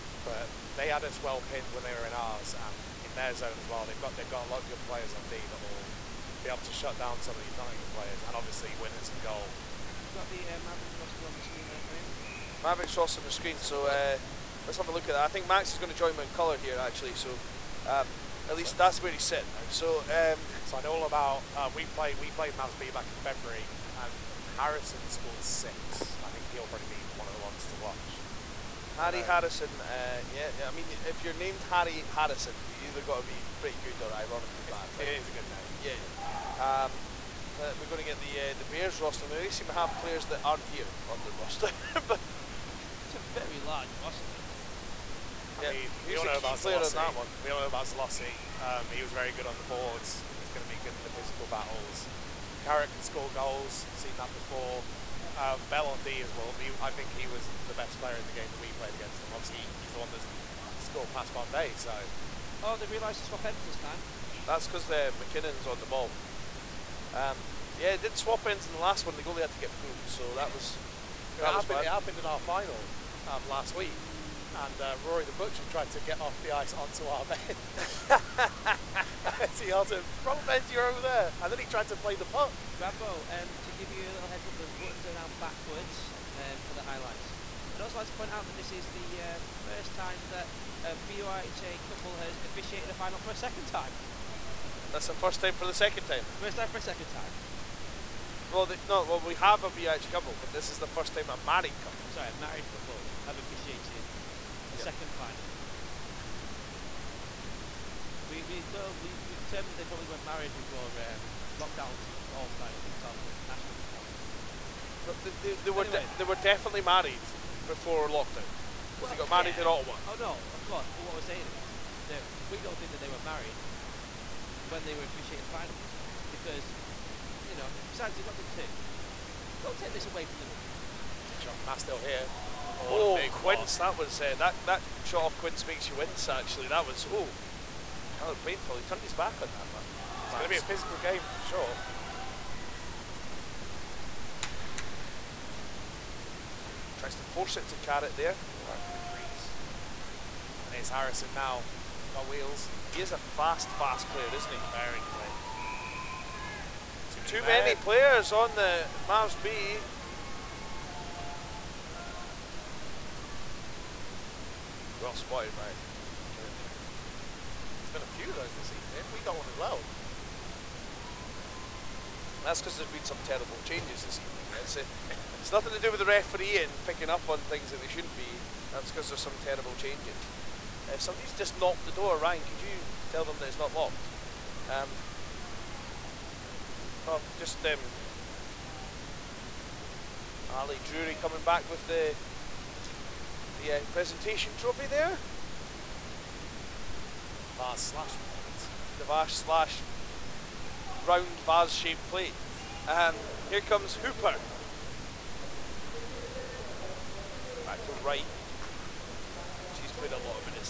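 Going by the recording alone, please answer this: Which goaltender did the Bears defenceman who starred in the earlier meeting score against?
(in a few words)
Bombay.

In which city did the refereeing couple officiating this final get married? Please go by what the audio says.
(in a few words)
Ottawa.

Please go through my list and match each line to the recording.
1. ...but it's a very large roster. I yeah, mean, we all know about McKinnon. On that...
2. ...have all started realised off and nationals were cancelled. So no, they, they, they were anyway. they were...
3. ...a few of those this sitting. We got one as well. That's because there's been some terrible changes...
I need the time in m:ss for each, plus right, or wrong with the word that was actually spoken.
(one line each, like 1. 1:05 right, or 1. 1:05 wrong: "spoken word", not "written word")
1. 0:42 wrong: "Zlossi", not "McKinnon"
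2. 1:52 wrong: "kicked", not "realised"
3. 2:48 wrong: "evening", not "sitting".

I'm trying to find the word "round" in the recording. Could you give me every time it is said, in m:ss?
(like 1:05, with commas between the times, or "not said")
3:21.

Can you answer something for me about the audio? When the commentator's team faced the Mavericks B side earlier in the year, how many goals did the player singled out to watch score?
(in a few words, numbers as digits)
6.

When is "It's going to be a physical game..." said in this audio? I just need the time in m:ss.
2:20.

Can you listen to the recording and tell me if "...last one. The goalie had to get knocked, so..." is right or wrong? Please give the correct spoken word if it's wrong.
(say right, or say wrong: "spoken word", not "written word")
wrong: "pulled", not "knocked".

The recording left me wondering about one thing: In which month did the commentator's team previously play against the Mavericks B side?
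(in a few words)
February.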